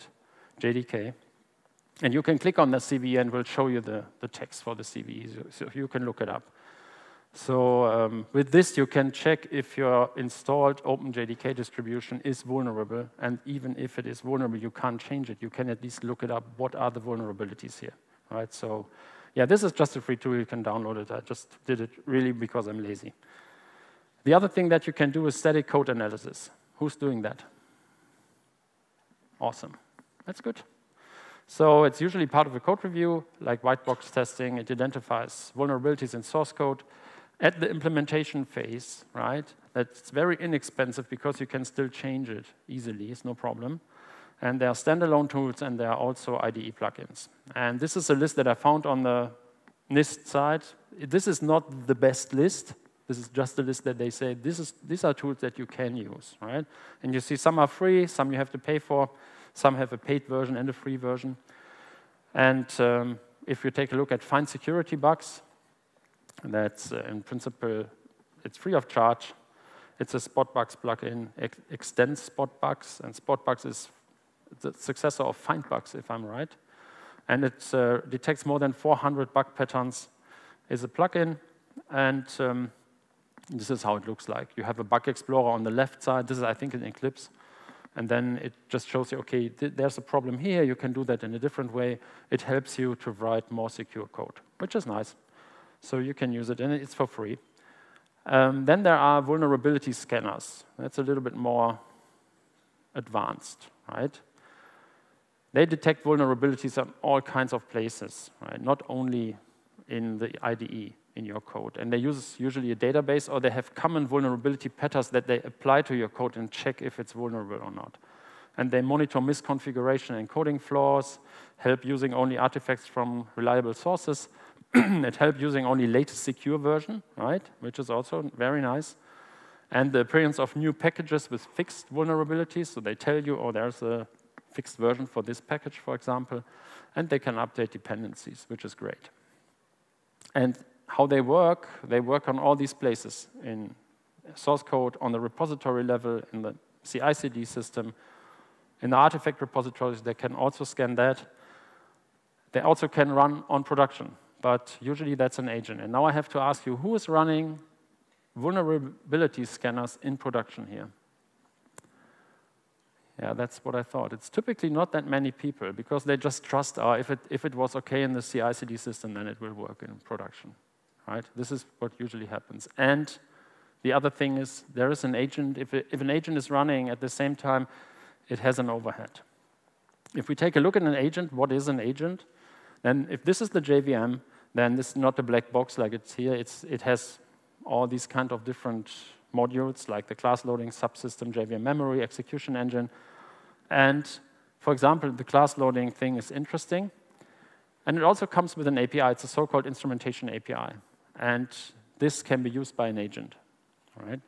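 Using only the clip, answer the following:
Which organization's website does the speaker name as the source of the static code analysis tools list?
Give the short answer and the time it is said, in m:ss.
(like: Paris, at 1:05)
NIST, at 0:49.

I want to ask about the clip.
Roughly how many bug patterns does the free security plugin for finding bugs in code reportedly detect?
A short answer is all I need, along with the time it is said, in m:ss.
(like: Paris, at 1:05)
more than 400, at 1:18.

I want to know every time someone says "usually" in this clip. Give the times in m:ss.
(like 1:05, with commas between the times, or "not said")
0:31, 1:52, 2:34, 2:51.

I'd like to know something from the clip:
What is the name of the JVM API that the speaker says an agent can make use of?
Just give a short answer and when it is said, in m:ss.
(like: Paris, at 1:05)
instrumentation API, at 3:19.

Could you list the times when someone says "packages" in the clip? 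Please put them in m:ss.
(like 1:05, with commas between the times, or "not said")
2:10, 2:15.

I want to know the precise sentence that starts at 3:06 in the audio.
It's, it has all these kind of different modules like the class loading subsystem, JVM memory, execution engine.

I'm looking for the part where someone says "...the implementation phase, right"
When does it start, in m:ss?
0:37.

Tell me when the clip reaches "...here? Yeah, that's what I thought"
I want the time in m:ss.
2:40.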